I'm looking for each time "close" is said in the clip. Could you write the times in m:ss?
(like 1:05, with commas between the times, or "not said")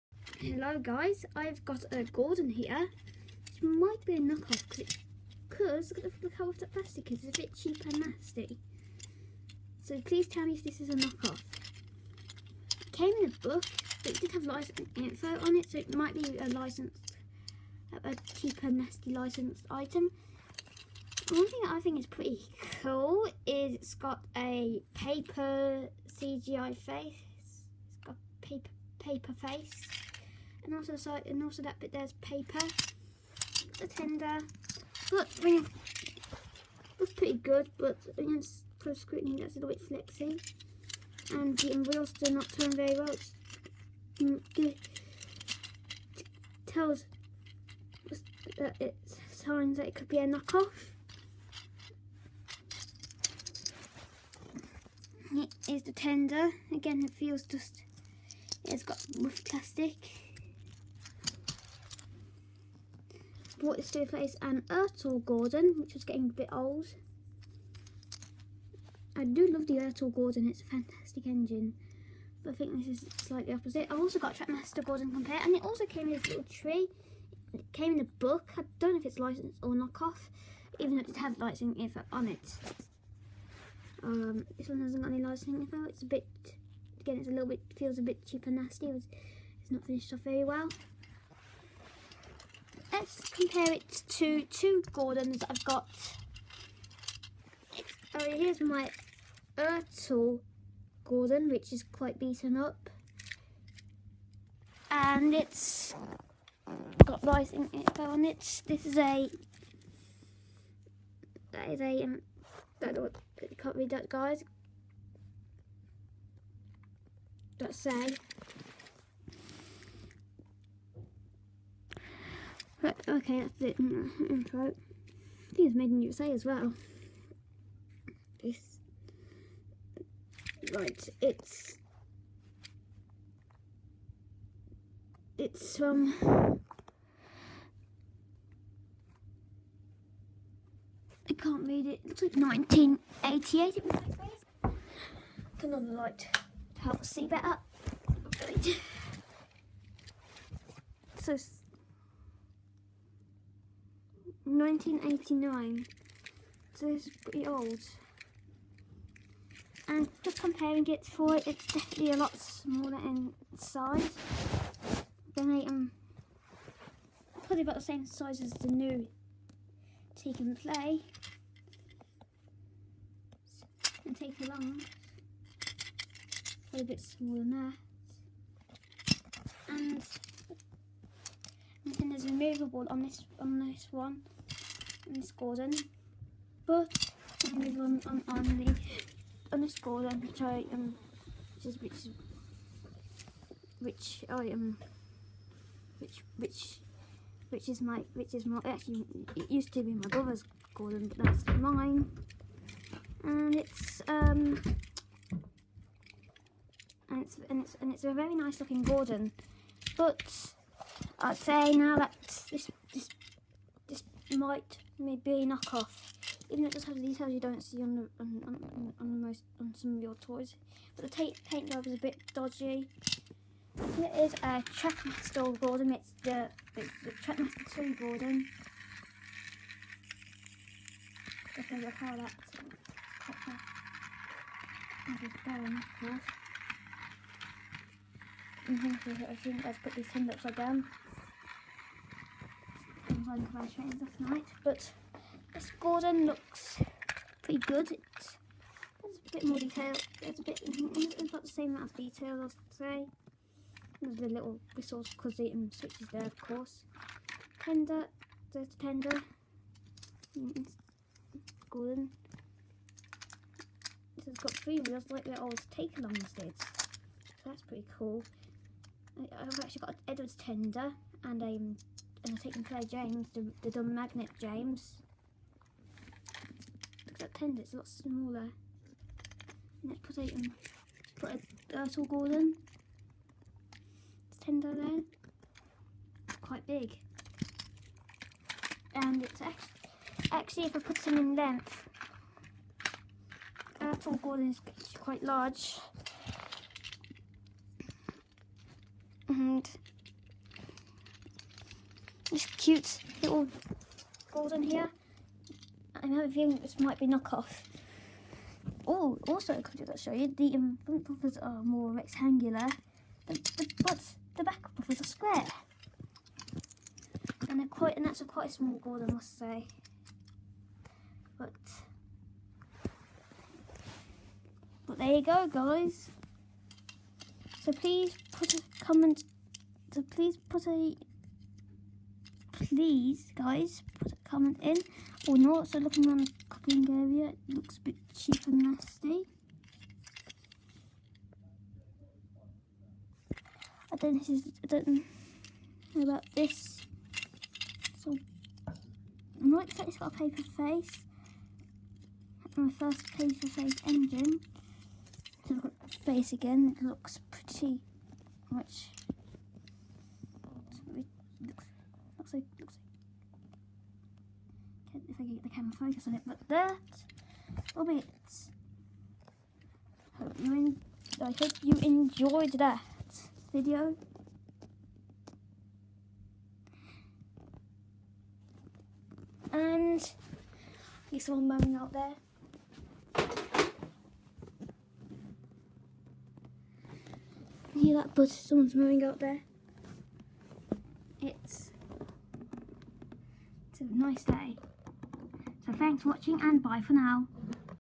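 0:38.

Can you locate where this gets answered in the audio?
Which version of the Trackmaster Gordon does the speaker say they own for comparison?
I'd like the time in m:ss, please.
3:47.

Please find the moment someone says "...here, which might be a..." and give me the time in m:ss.
0:02.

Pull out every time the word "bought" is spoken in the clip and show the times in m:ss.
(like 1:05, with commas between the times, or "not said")
1:03.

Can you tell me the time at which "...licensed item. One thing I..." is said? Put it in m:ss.
0:19.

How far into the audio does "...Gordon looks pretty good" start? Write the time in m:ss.
4:05.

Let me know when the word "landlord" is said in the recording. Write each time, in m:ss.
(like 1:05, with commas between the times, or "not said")
not said.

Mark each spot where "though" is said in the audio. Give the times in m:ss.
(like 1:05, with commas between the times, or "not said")
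1:20, 3:36.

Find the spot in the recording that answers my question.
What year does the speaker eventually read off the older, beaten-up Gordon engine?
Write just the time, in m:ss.
2:34.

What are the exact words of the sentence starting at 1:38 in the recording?
Oh, here's my Ertl Gordon, which is quite beaten up.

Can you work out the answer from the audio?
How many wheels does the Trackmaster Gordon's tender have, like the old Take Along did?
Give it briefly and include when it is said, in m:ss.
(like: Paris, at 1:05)
Three, at 4:24.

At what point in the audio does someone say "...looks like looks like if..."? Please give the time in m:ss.
6:02.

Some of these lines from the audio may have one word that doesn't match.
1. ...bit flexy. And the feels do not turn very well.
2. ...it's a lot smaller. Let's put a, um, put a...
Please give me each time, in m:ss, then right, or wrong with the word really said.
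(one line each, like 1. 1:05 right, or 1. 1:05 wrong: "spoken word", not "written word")
1. 0:39 wrong: "wheels", not "feels"
2. 4:37 right.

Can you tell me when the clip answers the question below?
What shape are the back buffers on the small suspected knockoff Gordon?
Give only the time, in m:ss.
5:15.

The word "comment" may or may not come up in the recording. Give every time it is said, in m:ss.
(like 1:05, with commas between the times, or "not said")
5:28, 5:34.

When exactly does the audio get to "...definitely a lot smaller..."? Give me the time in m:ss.
2:41.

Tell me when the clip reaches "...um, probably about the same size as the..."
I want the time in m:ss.
2:45.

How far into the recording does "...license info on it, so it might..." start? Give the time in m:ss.
0:14.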